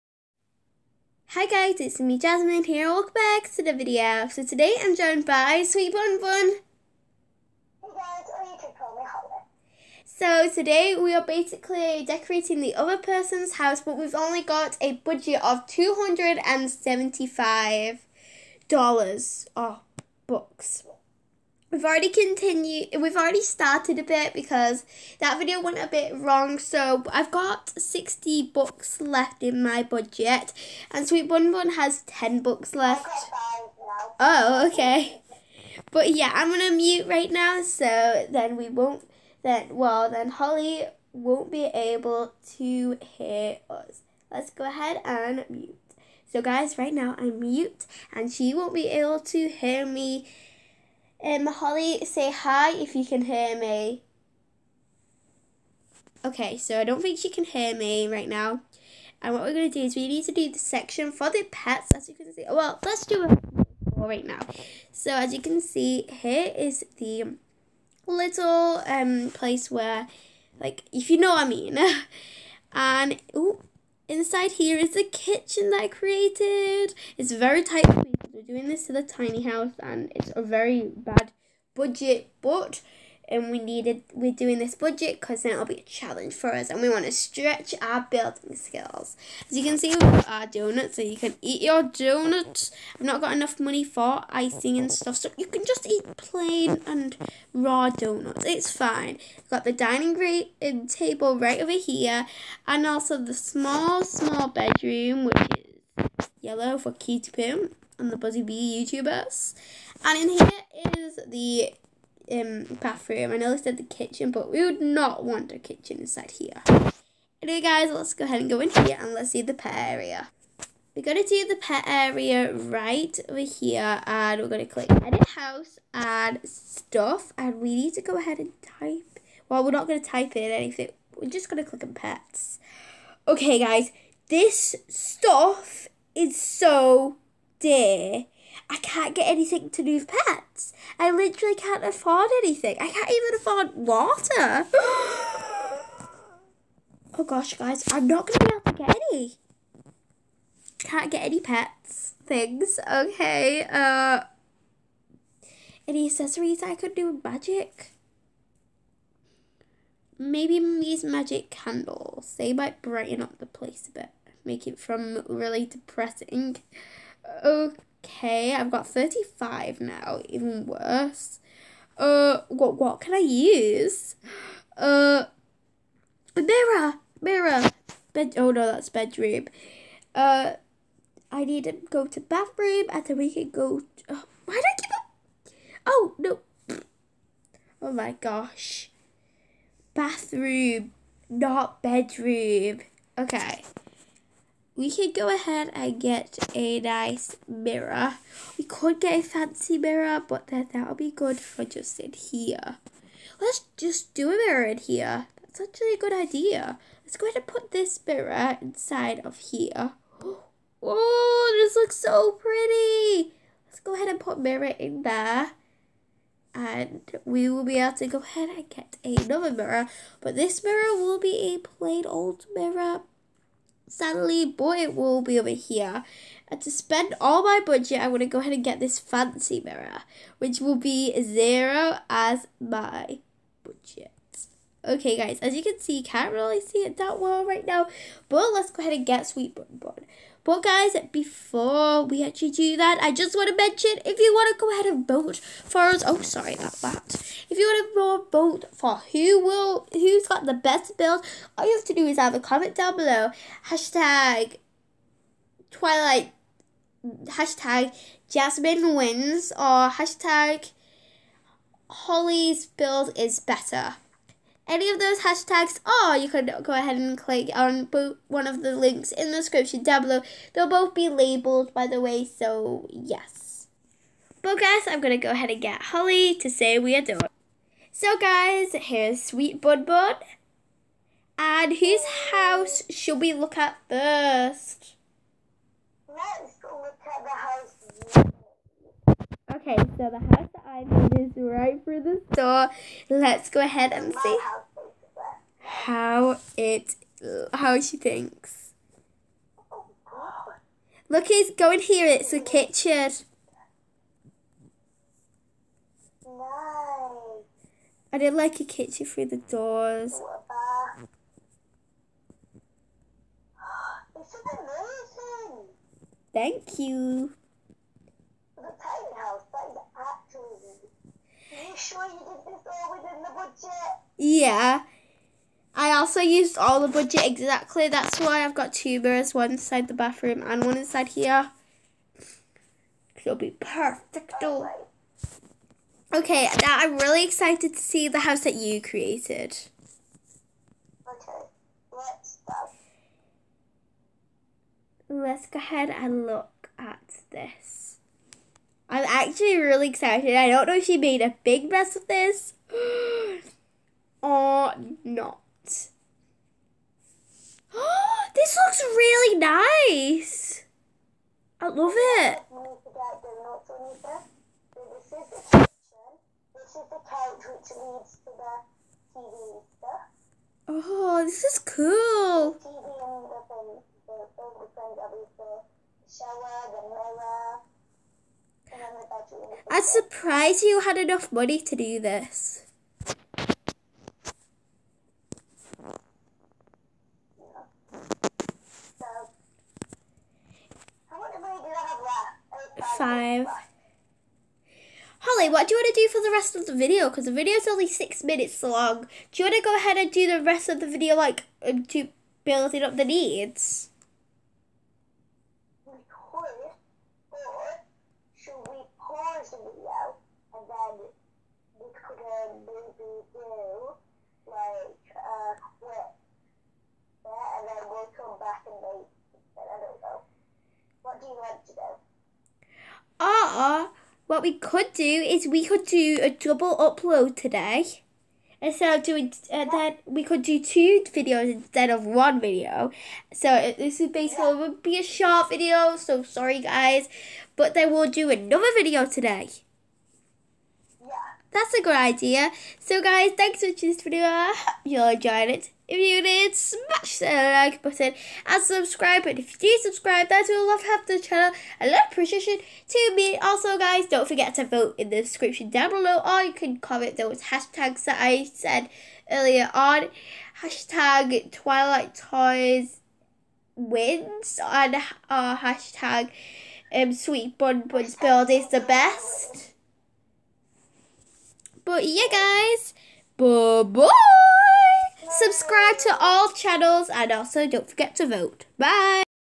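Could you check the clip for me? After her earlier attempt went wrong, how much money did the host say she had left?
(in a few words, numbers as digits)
60 bucks.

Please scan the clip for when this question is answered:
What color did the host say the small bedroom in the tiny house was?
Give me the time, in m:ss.
1:46.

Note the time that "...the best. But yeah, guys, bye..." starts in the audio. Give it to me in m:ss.
7:48.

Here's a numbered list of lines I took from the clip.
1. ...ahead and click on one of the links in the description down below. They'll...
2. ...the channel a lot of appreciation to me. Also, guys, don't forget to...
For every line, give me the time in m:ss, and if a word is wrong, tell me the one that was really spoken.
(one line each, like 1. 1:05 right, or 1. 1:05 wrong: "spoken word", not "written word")
1. 4:26 right
2. 7:31 right.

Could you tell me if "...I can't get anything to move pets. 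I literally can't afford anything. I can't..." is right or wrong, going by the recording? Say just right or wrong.
right.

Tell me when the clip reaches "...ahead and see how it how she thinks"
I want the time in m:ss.
4:53.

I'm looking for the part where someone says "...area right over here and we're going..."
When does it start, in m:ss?
2:01.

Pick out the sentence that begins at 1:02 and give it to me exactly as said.
Well, let's do it right now.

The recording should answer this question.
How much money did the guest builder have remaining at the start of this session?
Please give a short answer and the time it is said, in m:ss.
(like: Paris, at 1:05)
10 bucks, at 0:32.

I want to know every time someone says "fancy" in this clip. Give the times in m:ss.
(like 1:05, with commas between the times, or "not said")
3:19, 3:48.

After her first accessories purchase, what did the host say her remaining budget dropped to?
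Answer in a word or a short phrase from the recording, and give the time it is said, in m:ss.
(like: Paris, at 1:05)
35, at 2:48.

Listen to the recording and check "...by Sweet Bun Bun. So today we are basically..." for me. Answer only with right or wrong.
right.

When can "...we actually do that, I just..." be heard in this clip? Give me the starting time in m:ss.
4:02.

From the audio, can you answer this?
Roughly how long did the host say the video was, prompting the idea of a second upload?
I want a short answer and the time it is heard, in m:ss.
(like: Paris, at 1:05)
Six minutes, at 6:37.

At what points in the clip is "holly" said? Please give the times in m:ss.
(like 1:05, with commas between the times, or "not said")
0:40, 0:51, 4:21, 4:35, 6:35.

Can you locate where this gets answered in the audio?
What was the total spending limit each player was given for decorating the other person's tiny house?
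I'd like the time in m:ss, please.
0:15.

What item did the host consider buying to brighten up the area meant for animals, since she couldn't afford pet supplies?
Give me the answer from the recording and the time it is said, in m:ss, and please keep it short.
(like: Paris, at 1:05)
Magic candles, at 2:41.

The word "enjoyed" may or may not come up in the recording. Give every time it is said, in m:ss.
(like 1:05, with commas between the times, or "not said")
7:25.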